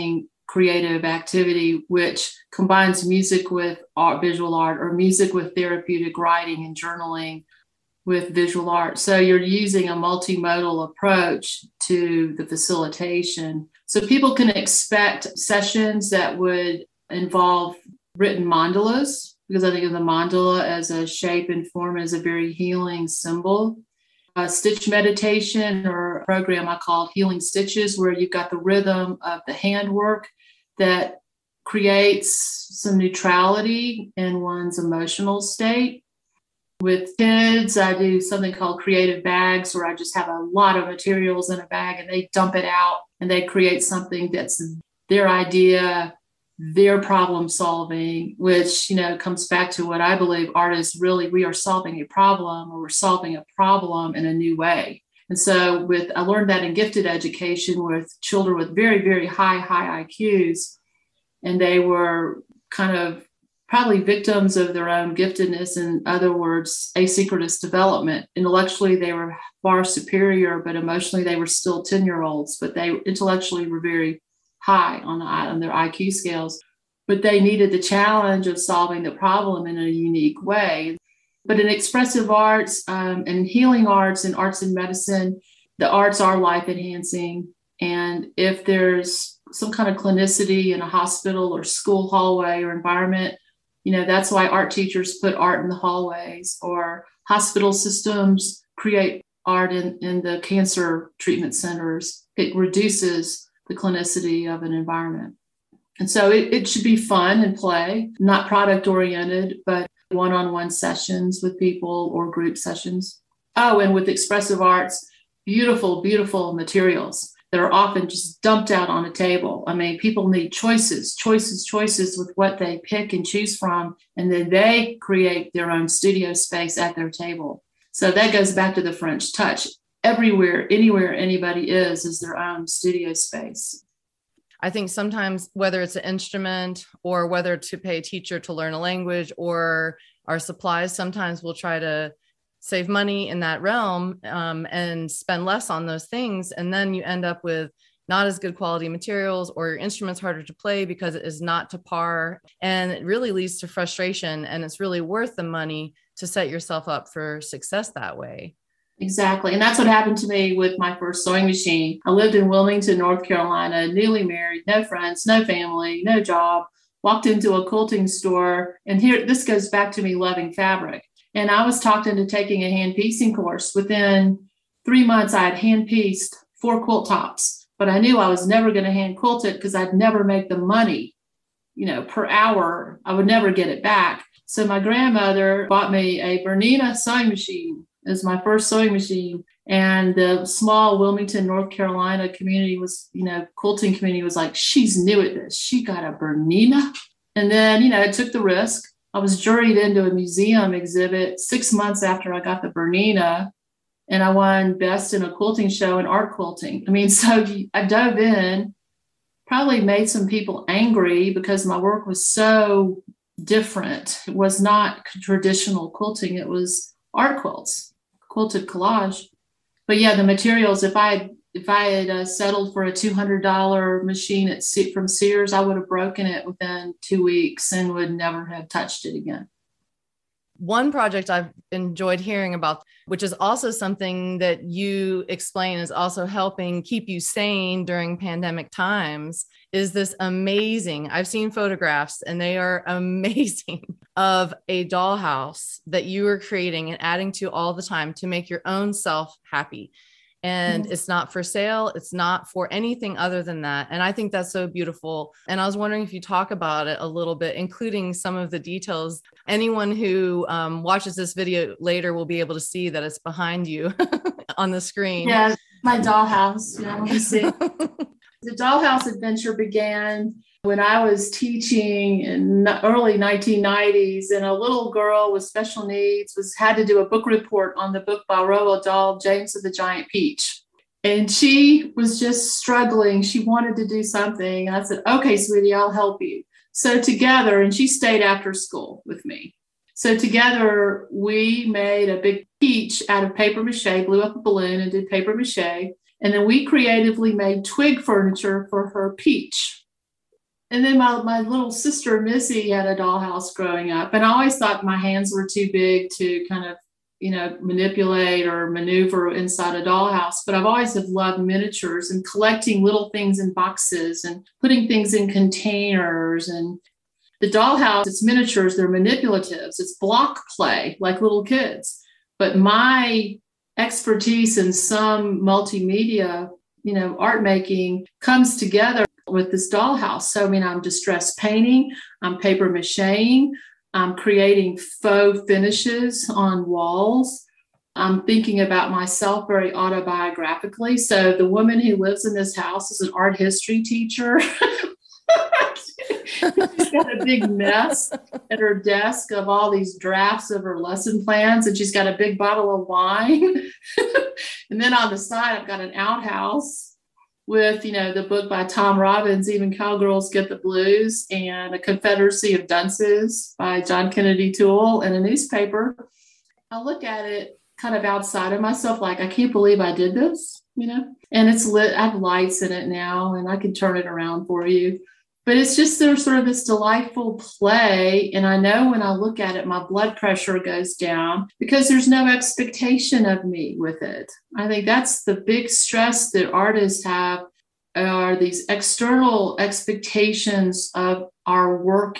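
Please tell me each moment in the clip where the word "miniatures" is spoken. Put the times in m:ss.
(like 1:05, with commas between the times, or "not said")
5:11, 5:18.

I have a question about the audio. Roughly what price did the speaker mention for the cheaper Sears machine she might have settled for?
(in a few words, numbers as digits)
$200.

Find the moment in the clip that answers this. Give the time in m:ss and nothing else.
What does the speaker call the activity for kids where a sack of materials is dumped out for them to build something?
0:38.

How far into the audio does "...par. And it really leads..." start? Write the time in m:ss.
2:31.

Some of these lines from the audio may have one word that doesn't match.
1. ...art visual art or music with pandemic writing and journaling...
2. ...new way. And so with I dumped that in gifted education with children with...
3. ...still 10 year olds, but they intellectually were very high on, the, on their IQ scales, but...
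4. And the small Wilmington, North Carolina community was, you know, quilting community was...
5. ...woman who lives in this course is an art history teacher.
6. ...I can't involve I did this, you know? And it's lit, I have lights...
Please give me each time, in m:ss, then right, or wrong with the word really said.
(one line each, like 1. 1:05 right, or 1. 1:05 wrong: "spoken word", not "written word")
1. 0:03 wrong: "therapeutic", not "pandemic"
2. 0:54 wrong: "learned", not "dumped"
3. 1:11 right
4. 3:09 right
5. 5:41 wrong: "house", not "course"
6. 6:09 wrong: "believe", not "involve".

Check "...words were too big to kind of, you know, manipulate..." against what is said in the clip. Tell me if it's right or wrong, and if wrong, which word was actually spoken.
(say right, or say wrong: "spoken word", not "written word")
wrong: "hands", not "words".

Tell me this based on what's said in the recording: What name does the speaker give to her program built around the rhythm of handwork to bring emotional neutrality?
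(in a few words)
Healing Stitches.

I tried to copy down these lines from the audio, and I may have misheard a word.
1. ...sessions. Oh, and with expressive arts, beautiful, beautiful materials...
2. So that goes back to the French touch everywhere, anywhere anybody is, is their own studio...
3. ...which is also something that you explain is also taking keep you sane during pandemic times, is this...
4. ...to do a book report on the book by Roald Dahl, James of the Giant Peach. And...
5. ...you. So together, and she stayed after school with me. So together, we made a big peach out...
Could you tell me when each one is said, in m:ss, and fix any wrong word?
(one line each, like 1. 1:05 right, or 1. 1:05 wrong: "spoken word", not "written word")
1. 1:52 right
2. 2:07 right
3. 3:53 wrong: "helping", not "taking"
4. 4:36 right
5. 4:46 right.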